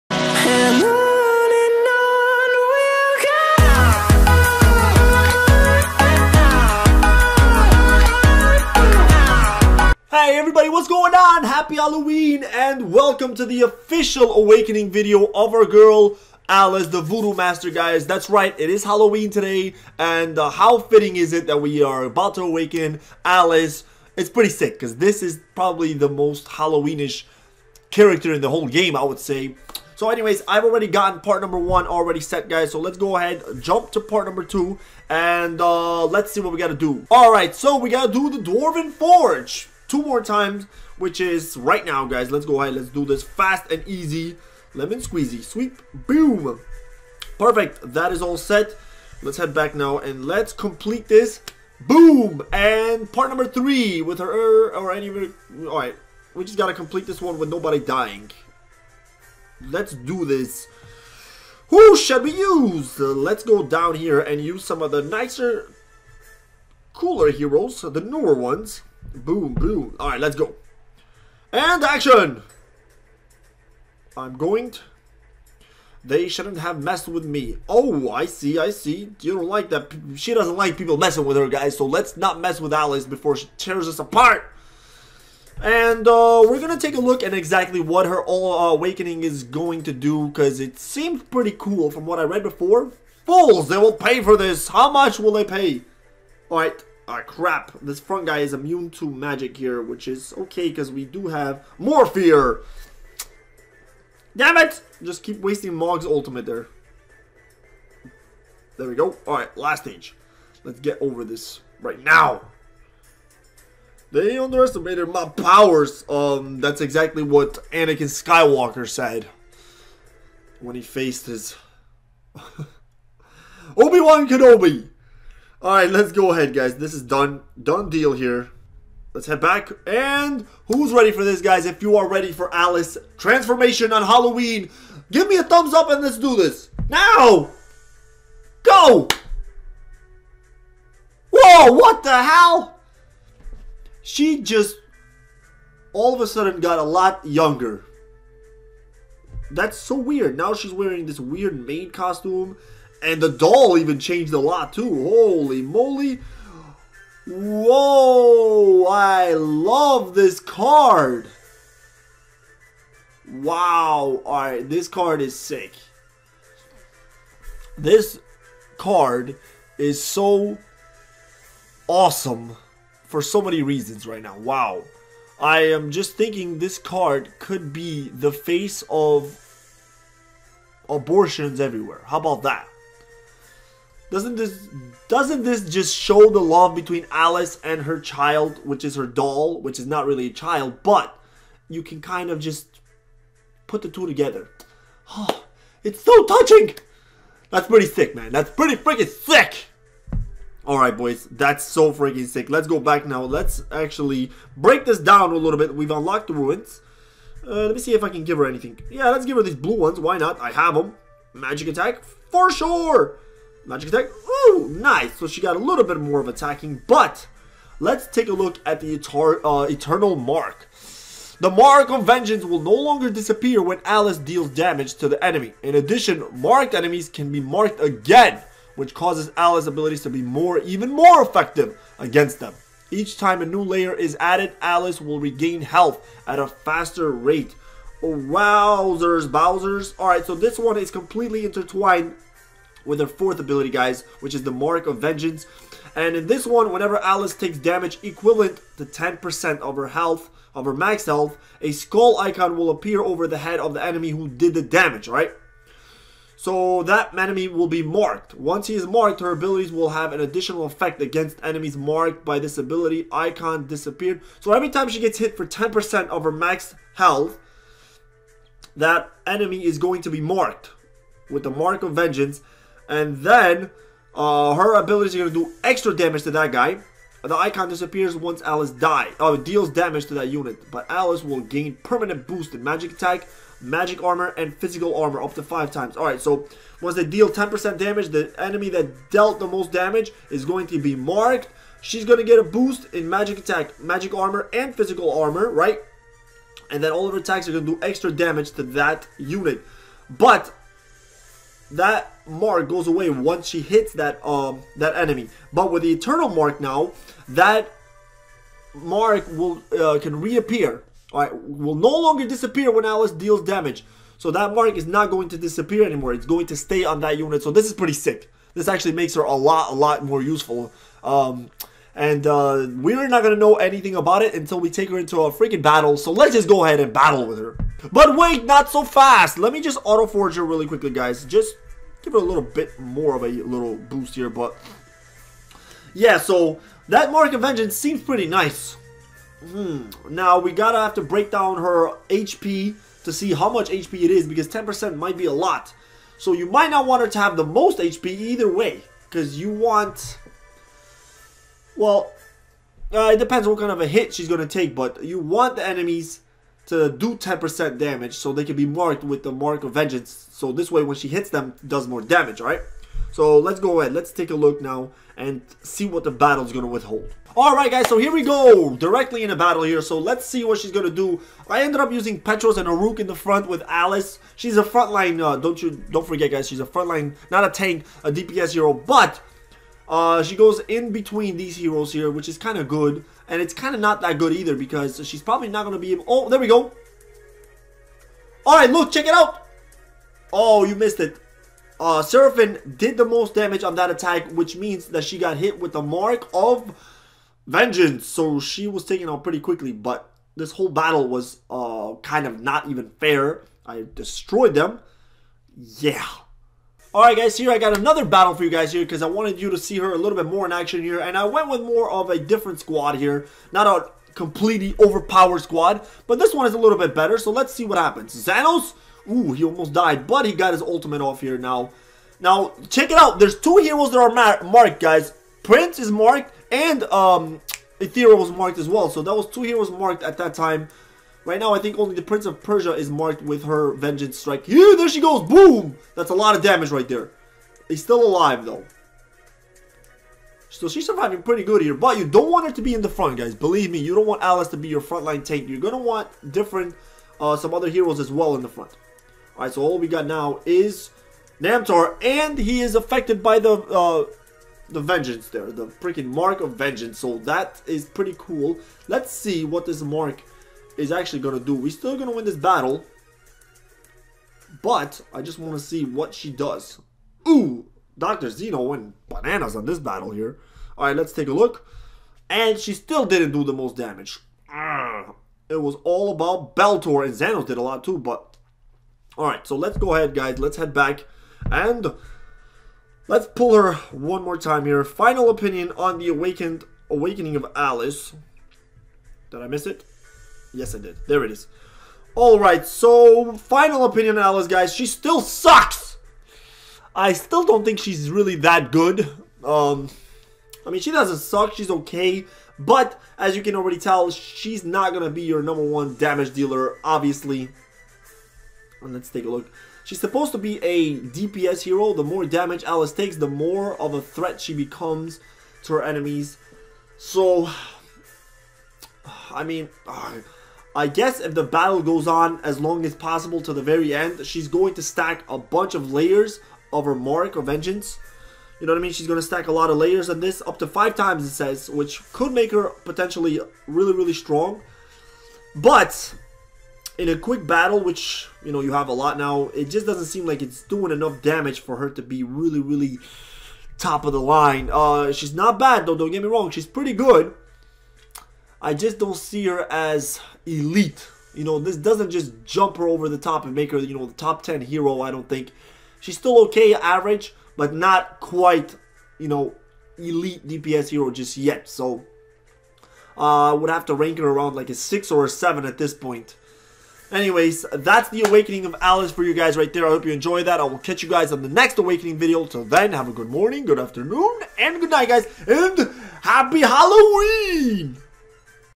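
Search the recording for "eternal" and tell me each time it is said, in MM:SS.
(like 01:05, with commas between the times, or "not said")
03:39, 05:05.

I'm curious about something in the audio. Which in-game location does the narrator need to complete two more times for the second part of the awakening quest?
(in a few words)
Dwarven Forge.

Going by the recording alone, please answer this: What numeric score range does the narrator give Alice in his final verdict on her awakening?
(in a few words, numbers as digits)
6 or 7.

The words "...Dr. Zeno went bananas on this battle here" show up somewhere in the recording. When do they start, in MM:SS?
07:47.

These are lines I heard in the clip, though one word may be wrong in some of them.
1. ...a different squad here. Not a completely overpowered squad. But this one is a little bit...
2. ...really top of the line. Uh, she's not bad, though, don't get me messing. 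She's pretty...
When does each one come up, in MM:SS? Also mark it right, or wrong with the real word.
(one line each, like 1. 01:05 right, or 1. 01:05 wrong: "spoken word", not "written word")
1. 06:52 right
2. 09:02 wrong: "wrong", not "messing".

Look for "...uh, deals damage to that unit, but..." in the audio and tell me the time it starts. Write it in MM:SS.
04:39.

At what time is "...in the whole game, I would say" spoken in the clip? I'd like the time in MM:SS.
00:28.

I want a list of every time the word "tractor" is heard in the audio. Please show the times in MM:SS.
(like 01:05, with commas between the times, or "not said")
not said.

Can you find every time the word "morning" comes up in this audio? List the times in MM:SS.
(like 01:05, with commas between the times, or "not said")
09:33.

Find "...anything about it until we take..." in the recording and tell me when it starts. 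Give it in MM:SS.
05:23.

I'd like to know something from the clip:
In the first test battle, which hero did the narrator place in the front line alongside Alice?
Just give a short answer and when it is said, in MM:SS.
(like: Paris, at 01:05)
Petros, at 06:12.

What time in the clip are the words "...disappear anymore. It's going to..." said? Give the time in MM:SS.
05:15.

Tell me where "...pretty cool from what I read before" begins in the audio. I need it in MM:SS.
01:31.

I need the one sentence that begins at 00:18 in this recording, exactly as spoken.
That's right, it is Halloween today and uh, how fitting is it that we are about to awaken Alice?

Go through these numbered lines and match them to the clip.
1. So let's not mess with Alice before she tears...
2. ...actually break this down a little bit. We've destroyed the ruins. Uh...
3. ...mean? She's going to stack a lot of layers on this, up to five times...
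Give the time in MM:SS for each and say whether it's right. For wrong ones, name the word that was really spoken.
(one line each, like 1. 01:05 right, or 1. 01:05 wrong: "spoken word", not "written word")
1. 01:21 right
2. 03:23 wrong: "unlocked", not "destroyed"
3. 08:48 right.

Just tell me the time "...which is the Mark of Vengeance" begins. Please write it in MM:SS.
04:04.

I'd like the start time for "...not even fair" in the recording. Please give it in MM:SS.
06:42.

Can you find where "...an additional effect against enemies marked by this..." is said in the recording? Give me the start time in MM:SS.
04:20.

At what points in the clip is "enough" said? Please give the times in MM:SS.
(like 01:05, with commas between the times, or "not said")
09:00.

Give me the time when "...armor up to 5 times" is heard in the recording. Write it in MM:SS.
04:44.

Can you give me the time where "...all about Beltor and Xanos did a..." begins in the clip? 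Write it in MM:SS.
07:55.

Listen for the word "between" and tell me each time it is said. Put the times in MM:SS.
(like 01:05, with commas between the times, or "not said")
03:06, 06:20.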